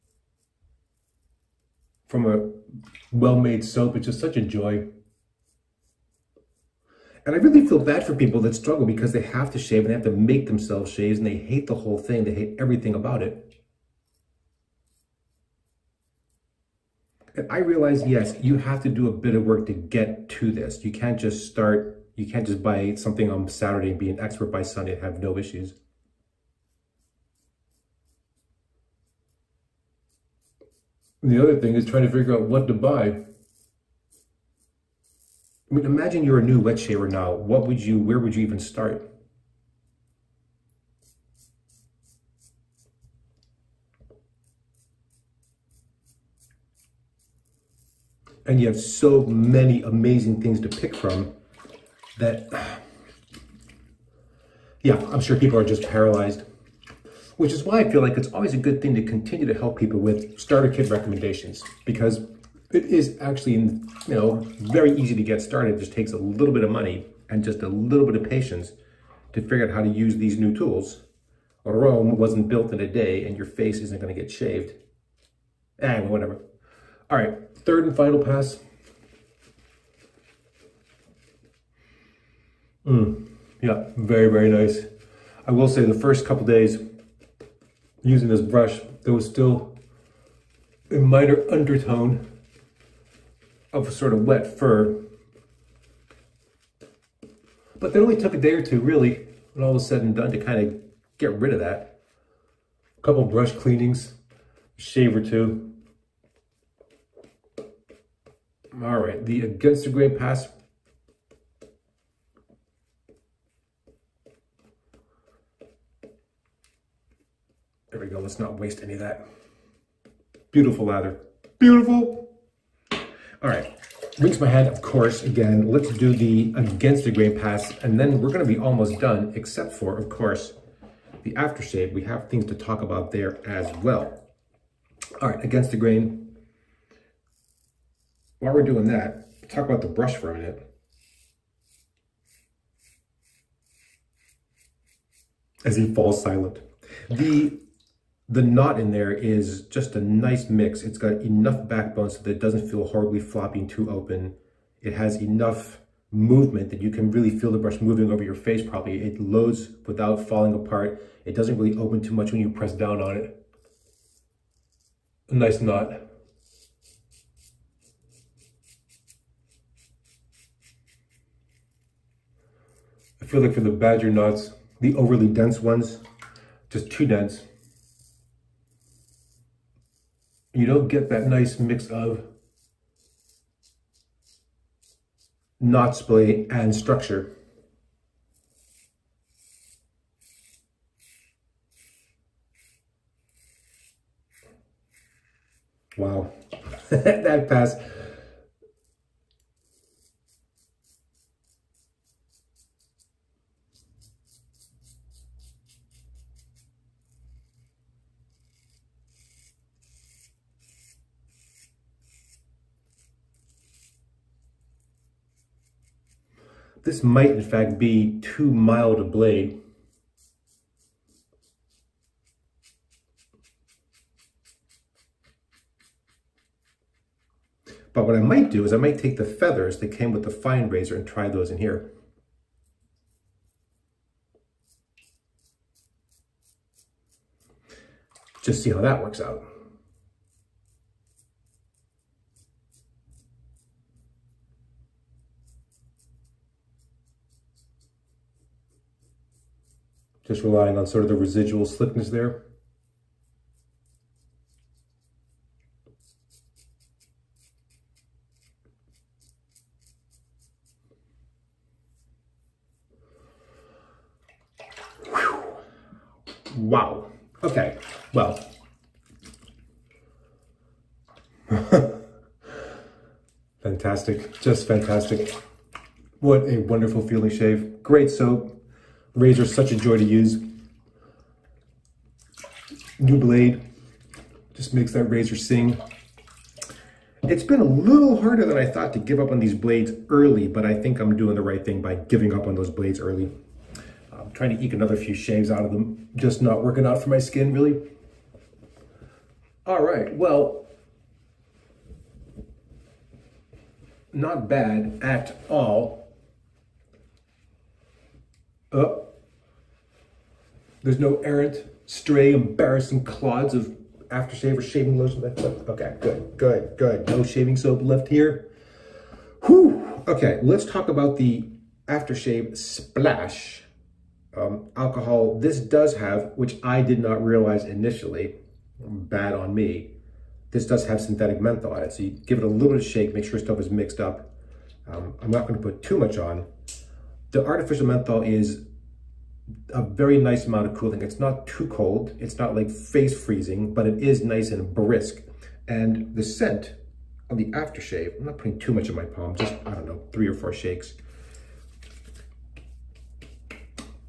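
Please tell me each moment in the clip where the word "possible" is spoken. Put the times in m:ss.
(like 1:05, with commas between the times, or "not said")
not said.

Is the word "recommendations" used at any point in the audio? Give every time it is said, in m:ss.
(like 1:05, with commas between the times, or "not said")
1:00.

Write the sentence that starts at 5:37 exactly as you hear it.
The artificial menthol is a very nice amount of cooling.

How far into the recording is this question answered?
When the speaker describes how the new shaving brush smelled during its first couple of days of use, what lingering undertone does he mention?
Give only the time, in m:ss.
1:34.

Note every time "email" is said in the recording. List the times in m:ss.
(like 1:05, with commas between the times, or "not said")
not said.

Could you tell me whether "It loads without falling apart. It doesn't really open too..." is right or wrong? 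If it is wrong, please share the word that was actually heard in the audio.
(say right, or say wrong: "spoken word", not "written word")
right.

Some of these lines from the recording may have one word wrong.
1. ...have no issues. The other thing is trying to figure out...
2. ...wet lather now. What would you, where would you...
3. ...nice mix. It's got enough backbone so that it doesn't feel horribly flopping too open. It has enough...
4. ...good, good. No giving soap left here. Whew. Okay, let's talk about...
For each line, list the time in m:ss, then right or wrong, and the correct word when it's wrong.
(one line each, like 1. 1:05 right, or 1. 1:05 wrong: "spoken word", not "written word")
1. 0:25 right
2. 0:36 wrong: "shaver", not "lather"
3. 2:29 right
4. 5:16 wrong: "shaving", not "giving".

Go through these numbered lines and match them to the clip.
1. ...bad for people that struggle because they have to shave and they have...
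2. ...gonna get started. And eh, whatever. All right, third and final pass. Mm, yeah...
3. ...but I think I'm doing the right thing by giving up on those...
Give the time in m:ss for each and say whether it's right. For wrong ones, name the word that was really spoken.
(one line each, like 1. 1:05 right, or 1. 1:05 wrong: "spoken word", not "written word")
1. 0:07 right
2. 1:13 wrong: "shaved", not "started"
3. 4:50 right.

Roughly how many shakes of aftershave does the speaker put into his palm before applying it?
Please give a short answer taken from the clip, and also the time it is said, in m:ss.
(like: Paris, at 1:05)
3 or 4, at 5:50.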